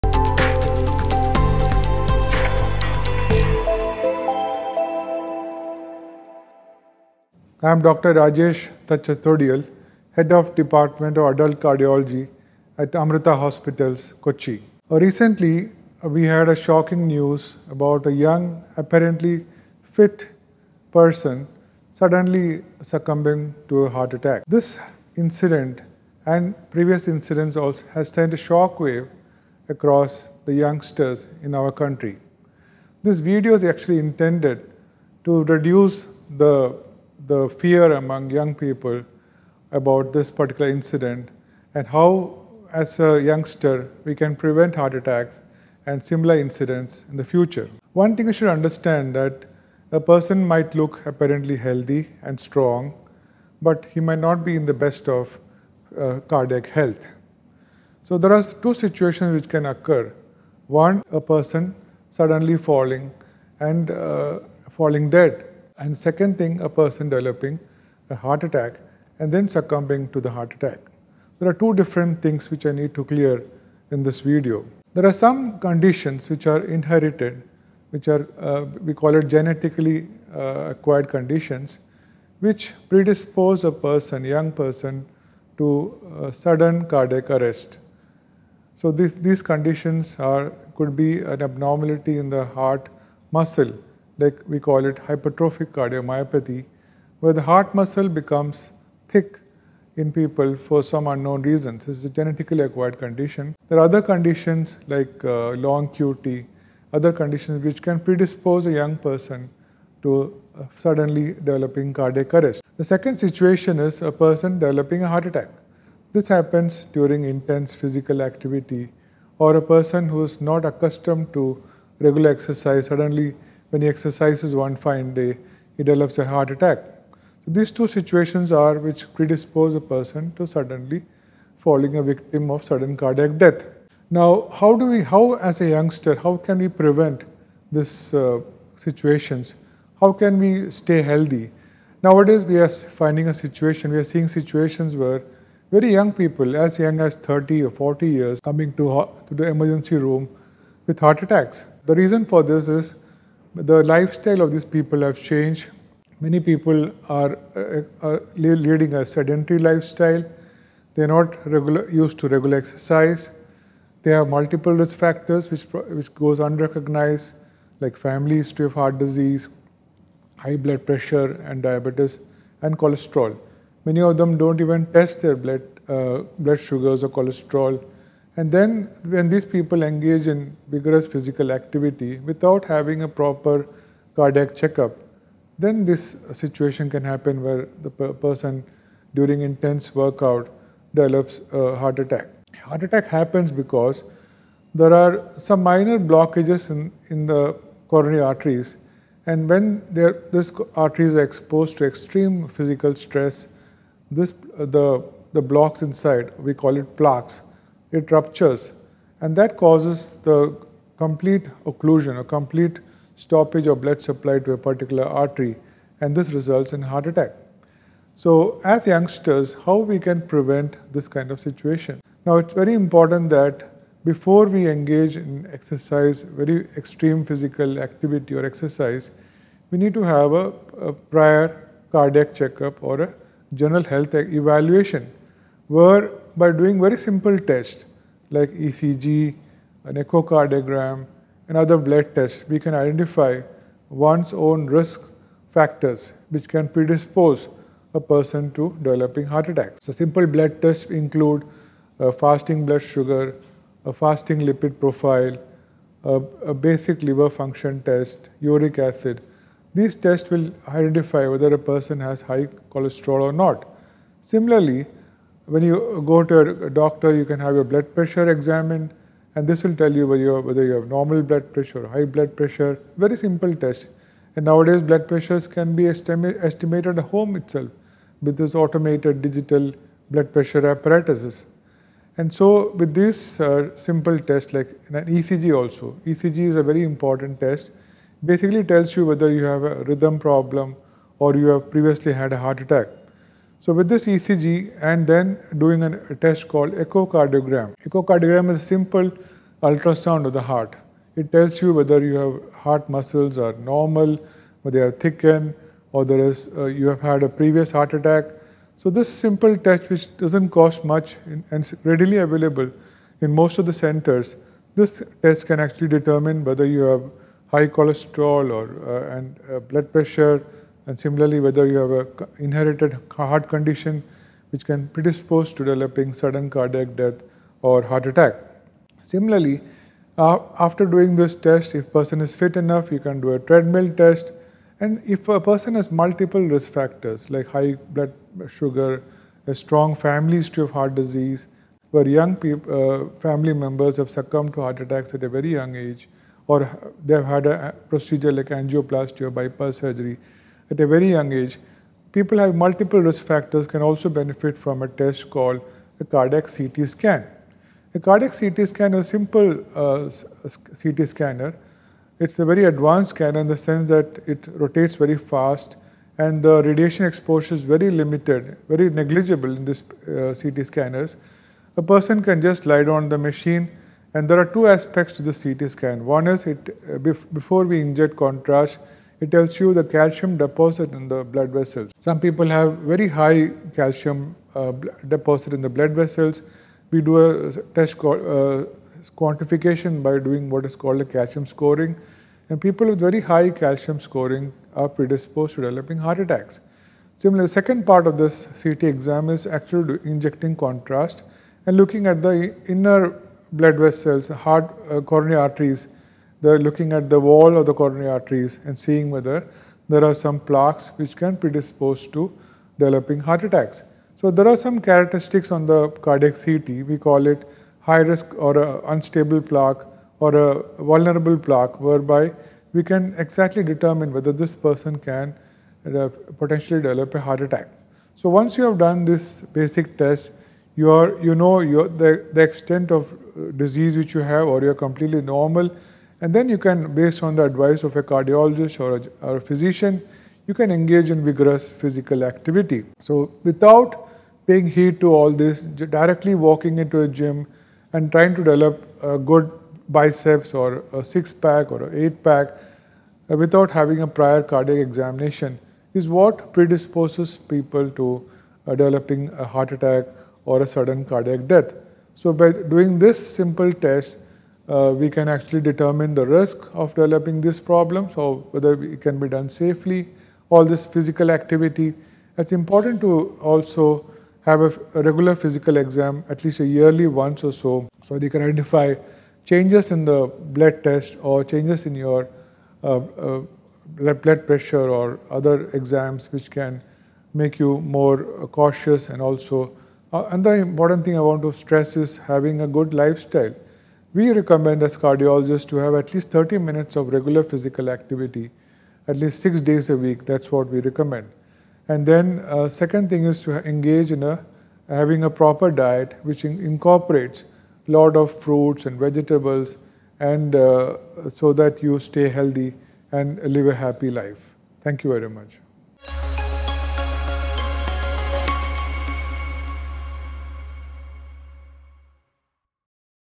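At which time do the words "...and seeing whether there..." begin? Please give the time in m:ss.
6:48.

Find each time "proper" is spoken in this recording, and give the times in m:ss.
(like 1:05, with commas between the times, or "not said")
3:03, 8:25.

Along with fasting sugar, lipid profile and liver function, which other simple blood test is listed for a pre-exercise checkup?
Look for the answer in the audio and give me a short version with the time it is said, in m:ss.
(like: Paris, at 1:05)
uric acid, at 4:18.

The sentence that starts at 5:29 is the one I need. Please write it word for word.
Similarly, uh, after doing this test, if person is fit enough, you can do a treadmill test.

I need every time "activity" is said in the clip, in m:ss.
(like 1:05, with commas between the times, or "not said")
1:58, 3:01, 3:47, 7:22, 7:51, 8:17.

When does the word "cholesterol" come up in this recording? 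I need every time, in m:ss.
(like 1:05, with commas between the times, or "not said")
2:52, 2:57, 4:22, 5:17.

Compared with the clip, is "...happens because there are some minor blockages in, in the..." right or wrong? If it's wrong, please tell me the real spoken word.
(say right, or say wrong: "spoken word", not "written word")
right.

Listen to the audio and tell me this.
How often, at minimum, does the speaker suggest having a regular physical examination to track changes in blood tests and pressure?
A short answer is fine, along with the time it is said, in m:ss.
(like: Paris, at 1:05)
yearly once, at 7:56.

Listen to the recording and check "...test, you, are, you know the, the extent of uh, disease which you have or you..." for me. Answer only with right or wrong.
right.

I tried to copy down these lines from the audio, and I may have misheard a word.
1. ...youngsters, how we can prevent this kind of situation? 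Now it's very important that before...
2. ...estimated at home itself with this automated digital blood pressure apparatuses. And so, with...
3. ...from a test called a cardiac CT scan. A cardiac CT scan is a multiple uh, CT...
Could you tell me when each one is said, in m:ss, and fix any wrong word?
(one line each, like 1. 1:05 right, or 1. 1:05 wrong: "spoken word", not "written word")
1. 3:38 right
2. 4:35 right
3. 5:54 wrong: "simple", not "multiple".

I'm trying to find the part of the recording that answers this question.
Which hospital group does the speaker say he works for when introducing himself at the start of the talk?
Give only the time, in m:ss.
0:12.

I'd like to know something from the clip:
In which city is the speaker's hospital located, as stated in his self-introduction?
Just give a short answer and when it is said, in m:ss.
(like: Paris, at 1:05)
Kochi, at 0:14.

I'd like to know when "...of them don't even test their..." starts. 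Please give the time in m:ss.
2:54.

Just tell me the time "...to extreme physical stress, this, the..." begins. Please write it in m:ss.
3:21.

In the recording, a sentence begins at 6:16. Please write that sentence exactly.
One is it, uh, before we inject contrast, it tells you the calcium deposit in the blood vessels.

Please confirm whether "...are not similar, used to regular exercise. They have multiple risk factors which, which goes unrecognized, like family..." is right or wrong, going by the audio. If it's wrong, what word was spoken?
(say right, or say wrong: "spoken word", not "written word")
wrong: "regular", not "similar".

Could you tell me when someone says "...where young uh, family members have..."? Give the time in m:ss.
5:41.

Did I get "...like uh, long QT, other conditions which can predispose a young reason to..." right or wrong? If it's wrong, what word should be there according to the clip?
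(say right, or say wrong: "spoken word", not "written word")
wrong: "person", not "reason".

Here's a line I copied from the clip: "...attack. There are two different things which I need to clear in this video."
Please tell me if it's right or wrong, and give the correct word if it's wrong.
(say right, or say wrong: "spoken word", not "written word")
right.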